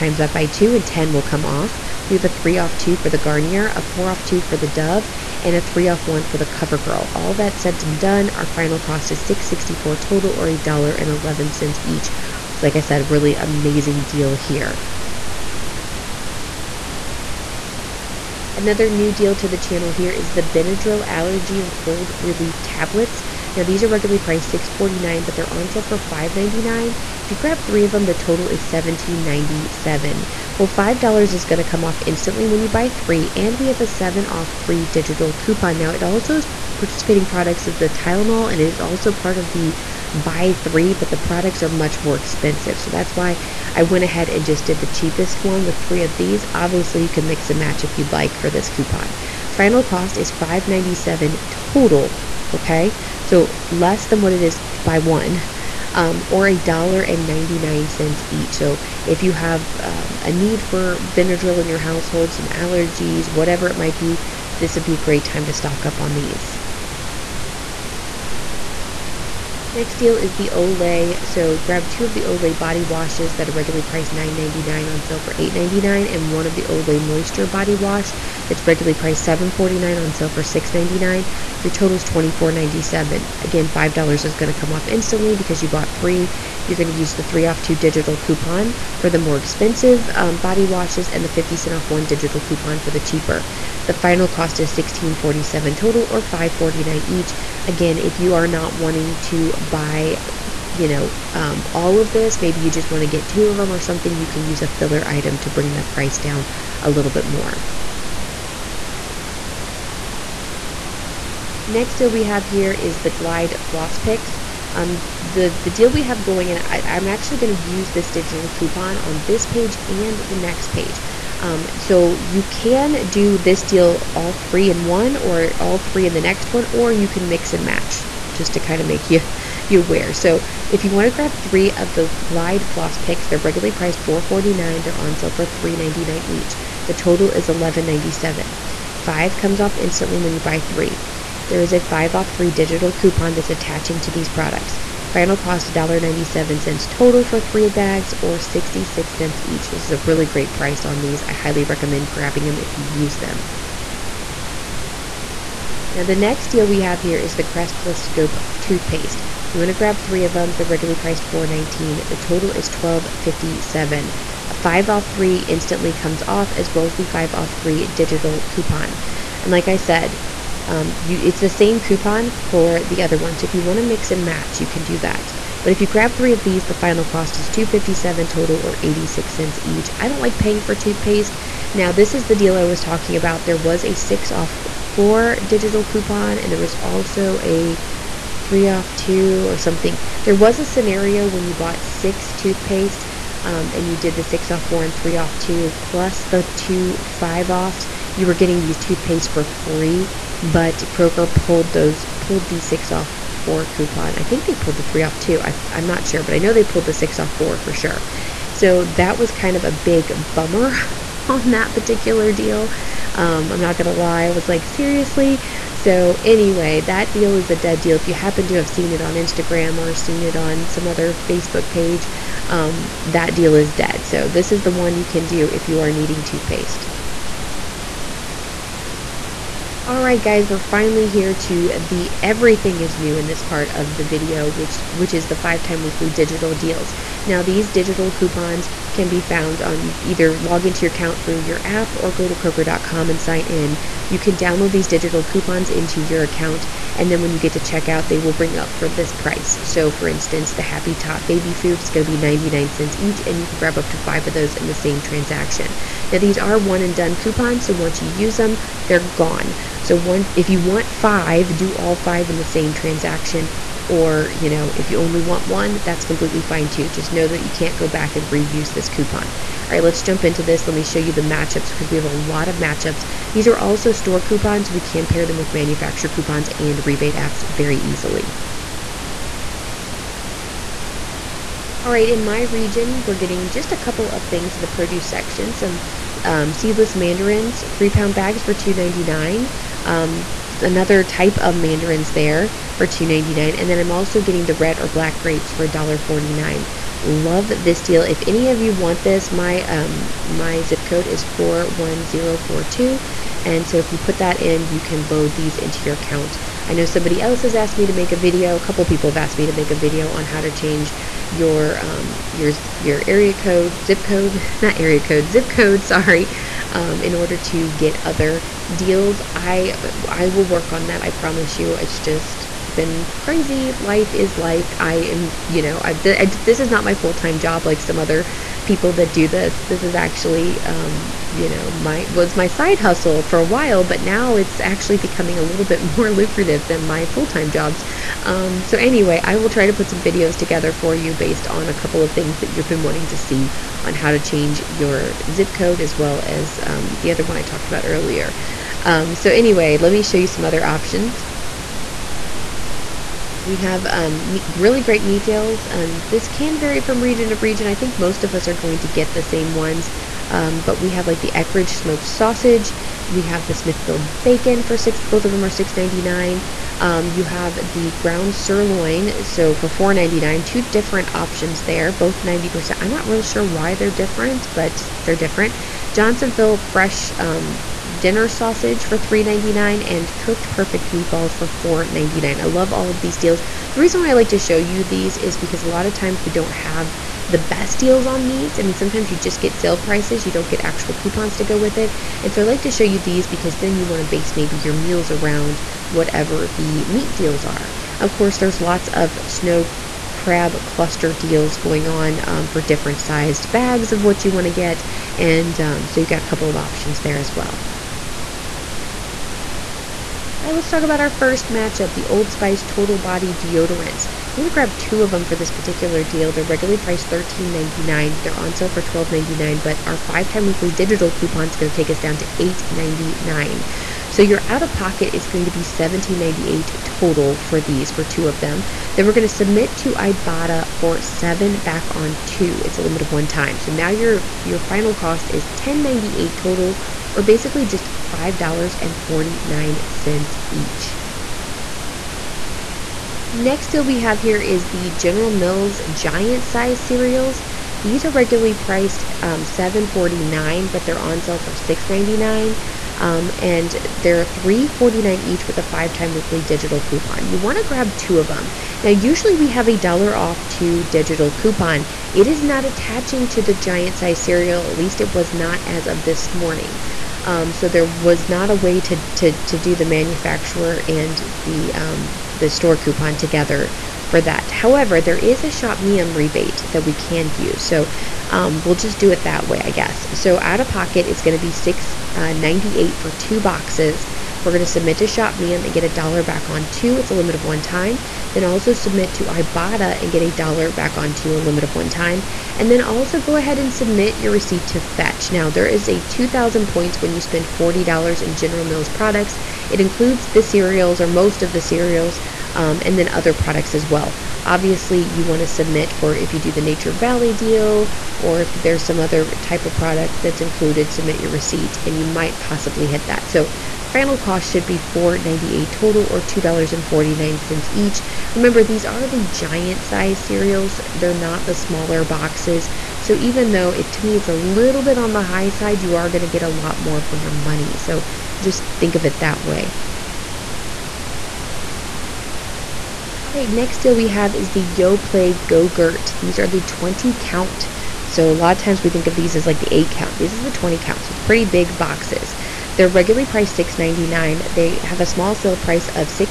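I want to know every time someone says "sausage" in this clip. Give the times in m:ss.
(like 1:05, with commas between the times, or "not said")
6:02, 6:18.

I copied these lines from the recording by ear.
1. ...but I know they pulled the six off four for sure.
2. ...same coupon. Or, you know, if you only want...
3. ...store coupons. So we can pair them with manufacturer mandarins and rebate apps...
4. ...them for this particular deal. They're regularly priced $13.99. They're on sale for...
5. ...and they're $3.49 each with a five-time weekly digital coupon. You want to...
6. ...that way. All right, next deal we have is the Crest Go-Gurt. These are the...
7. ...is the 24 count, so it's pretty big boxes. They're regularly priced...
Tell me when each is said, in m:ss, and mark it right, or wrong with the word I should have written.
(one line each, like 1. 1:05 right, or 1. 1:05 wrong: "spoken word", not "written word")
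1. 3:26 right
2. 4:22 wrong: "transaction", not "coupon"
3. 4:33 wrong: "coupons", not "mandarins"
4. 6:55 right
5. 7:33 right
6. 8:49 wrong: "Yoplait", not "Crest"
7. 9:00 wrong: "20", not "24".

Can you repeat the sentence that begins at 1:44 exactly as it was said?
You can use a filler item to bring that price down a little bit more.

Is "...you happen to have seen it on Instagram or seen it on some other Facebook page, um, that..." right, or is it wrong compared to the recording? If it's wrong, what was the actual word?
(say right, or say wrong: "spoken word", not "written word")
right.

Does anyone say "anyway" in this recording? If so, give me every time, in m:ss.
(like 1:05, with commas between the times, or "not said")
3:36, 5:38, 5:49.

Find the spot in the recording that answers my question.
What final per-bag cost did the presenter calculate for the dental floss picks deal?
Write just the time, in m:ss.
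2:28.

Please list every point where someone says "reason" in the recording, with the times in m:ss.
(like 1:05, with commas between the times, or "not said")
6:23.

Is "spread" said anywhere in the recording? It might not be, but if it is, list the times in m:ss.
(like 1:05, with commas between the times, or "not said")
not said.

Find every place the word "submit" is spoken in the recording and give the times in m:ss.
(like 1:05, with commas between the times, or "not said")
7:09, 8:04, 8:08, 8:13, 8:25, 8:30.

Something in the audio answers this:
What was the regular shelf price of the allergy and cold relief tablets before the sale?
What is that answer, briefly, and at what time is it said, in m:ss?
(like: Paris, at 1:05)
$6.49, at 0:24.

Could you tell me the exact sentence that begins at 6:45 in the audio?
And um, so you've got a couple of options there as well.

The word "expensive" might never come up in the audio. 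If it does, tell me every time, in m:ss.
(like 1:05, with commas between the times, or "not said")
0:42, 1:29.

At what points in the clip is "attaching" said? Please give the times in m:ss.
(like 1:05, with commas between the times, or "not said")
2:23, 7:42.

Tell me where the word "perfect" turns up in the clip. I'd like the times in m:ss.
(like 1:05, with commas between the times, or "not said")
6:20.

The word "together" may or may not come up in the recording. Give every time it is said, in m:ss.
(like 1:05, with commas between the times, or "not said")
5:40, 7:53.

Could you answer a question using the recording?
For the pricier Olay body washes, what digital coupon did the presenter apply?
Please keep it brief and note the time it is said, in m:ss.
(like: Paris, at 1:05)
3 off 2, at 1:27.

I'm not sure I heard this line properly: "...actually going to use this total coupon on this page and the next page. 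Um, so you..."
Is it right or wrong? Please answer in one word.
wrong.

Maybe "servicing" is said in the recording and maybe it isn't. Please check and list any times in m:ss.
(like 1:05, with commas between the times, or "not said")
not said.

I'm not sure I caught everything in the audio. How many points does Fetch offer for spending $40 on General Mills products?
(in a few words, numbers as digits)
2,000.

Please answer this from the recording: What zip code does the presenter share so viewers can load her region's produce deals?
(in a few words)
41042.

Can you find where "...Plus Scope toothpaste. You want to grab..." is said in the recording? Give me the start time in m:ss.
2:37.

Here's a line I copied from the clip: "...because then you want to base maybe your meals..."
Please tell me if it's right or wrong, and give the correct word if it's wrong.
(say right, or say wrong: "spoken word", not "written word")
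right.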